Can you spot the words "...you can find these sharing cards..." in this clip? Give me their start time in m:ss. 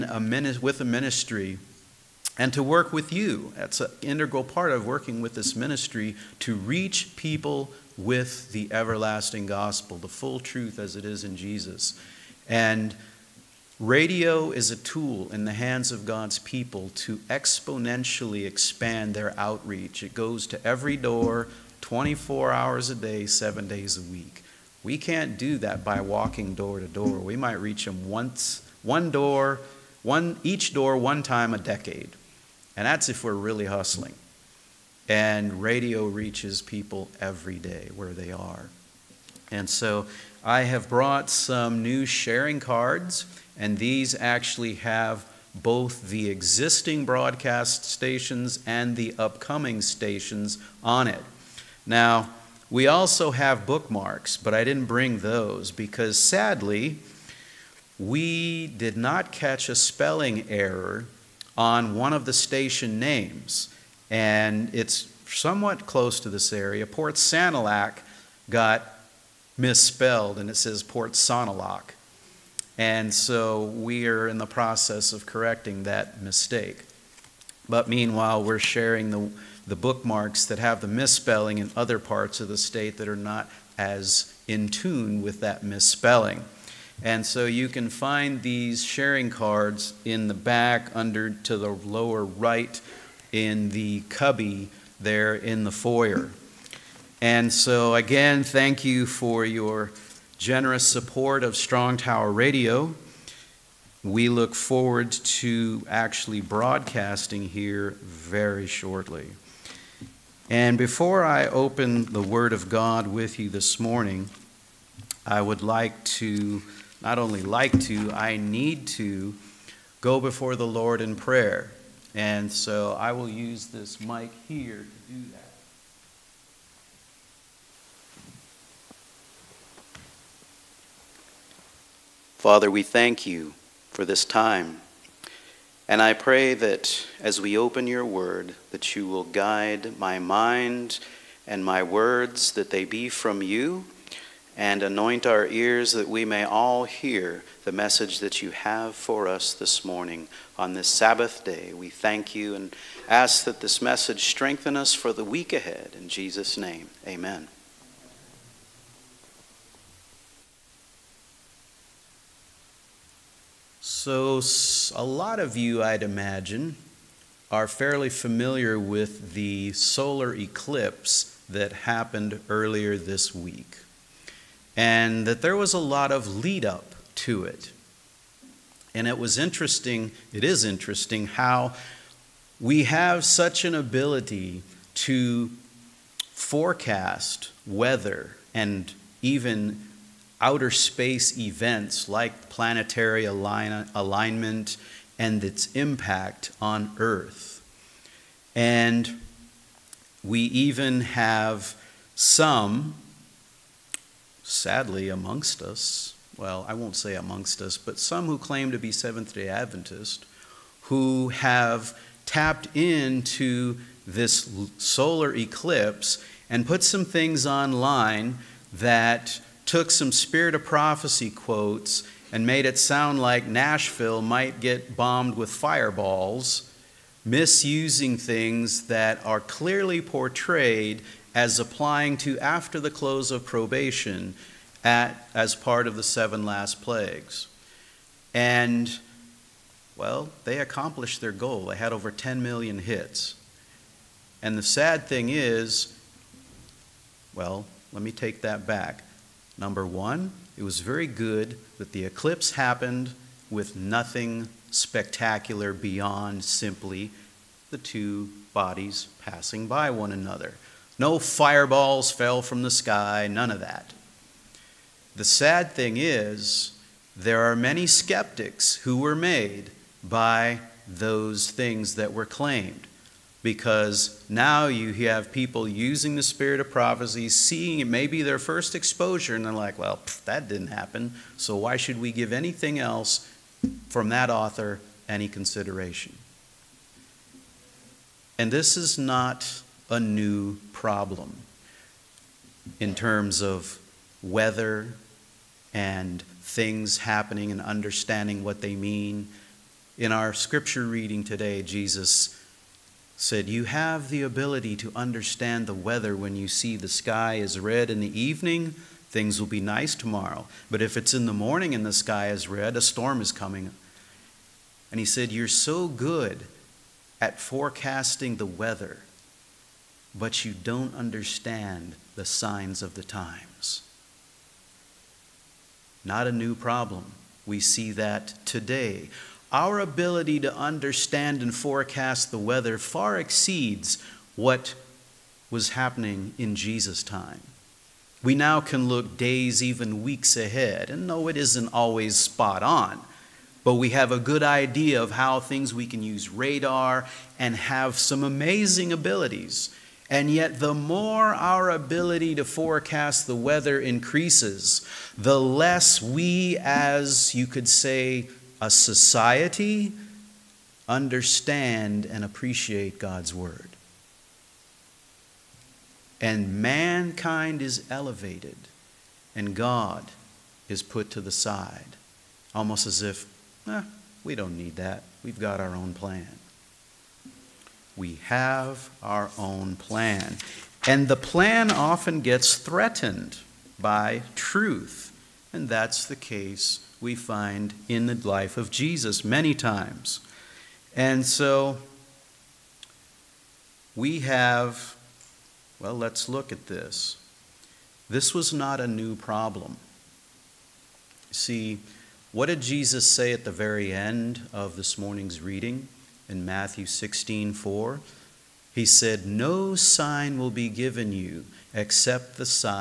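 1:27.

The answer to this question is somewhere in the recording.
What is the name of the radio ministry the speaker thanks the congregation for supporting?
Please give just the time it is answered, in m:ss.
1:41.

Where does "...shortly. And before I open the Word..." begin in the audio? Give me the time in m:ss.
1:48.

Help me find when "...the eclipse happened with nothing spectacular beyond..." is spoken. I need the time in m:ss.
4:11.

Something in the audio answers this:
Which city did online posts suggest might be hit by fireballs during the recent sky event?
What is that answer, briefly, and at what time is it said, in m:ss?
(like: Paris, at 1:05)
Nashville, at 3:43.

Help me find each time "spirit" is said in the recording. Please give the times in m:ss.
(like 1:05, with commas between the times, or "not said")
3:40, 4:36.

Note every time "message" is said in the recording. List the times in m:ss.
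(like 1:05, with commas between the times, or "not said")
2:27, 2:33.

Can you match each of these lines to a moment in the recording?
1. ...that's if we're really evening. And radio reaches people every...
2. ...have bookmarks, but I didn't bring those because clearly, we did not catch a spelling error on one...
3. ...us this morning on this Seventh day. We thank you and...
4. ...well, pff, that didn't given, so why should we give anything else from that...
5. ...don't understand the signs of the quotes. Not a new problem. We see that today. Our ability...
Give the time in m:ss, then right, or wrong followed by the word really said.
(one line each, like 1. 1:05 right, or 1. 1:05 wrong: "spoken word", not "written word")
1. 0:32 wrong: "hustling", not "evening"
2. 0:53 wrong: "sadly", not "clearly"
3. 2:29 wrong: "Sabbath", not "Seventh"
4. 4:39 wrong: "happen", not "given"
5. 5:20 wrong: "times", not "quotes".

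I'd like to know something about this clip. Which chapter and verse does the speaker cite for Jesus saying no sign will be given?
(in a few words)
Matthew 16:4.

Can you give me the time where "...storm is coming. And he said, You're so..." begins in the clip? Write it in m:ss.
5:12.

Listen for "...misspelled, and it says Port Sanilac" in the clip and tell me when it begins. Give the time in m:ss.
1:09.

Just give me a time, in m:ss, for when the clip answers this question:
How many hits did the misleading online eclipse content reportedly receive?
4:02.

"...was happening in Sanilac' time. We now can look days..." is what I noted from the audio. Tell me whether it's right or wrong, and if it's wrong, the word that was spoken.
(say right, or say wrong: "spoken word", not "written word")
wrong: "Jesus", not "Sanilac".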